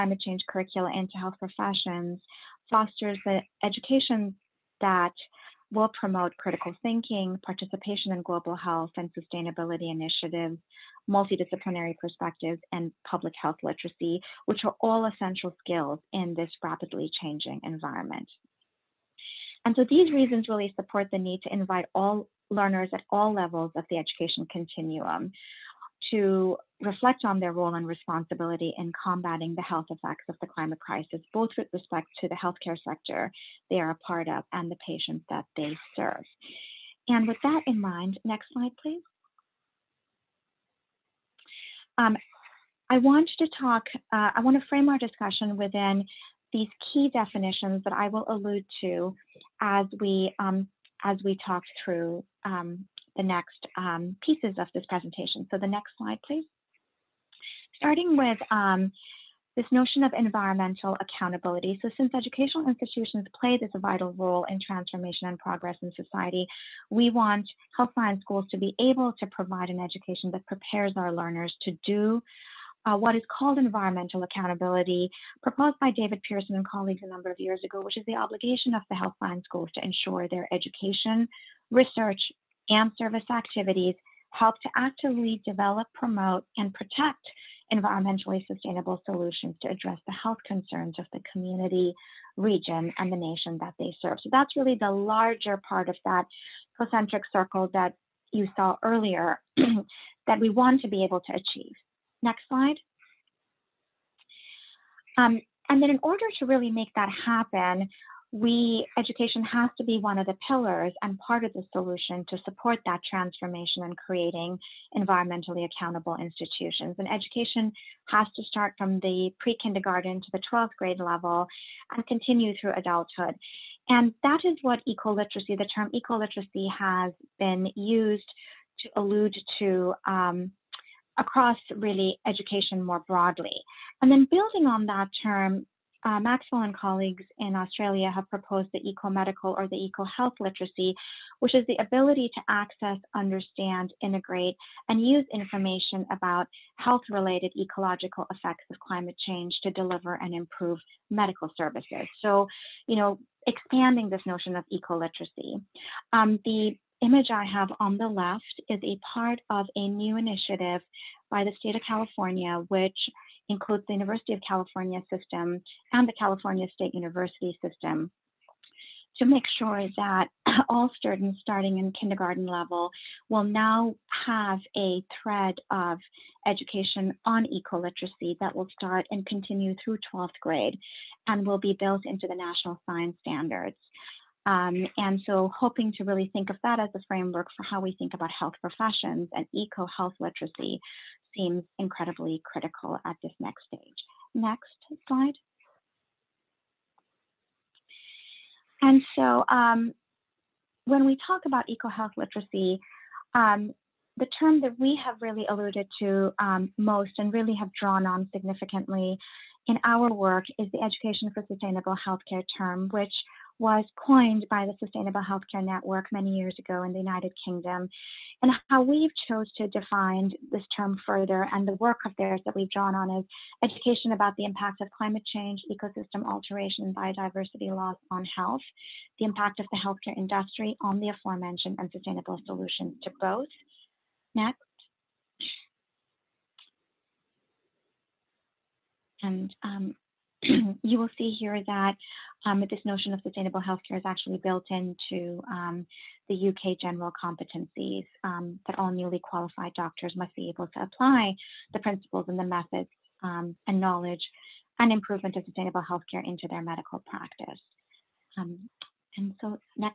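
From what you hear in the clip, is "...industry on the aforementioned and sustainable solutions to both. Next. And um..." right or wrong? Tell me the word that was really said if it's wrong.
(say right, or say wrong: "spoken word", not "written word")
right.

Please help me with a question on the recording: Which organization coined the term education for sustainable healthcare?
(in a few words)
Sustainable Healthcare Network.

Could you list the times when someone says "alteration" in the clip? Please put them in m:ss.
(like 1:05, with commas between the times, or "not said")
3:46.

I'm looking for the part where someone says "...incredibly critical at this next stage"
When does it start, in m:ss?
3:11.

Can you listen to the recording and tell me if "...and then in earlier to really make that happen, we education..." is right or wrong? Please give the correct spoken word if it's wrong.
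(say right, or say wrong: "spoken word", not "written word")
wrong: "order", not "earlier".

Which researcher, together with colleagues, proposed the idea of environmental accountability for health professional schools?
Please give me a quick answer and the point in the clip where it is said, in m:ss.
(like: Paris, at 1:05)
David Pearson, at 1:15.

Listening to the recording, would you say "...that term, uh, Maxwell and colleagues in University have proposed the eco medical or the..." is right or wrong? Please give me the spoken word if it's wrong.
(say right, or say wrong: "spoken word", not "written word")
wrong: "Australia", not "University".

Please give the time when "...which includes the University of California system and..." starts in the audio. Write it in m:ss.
2:42.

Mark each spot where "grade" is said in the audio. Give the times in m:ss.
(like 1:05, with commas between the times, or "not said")
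2:00, 3:00.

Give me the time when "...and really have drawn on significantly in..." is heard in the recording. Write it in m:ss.
3:27.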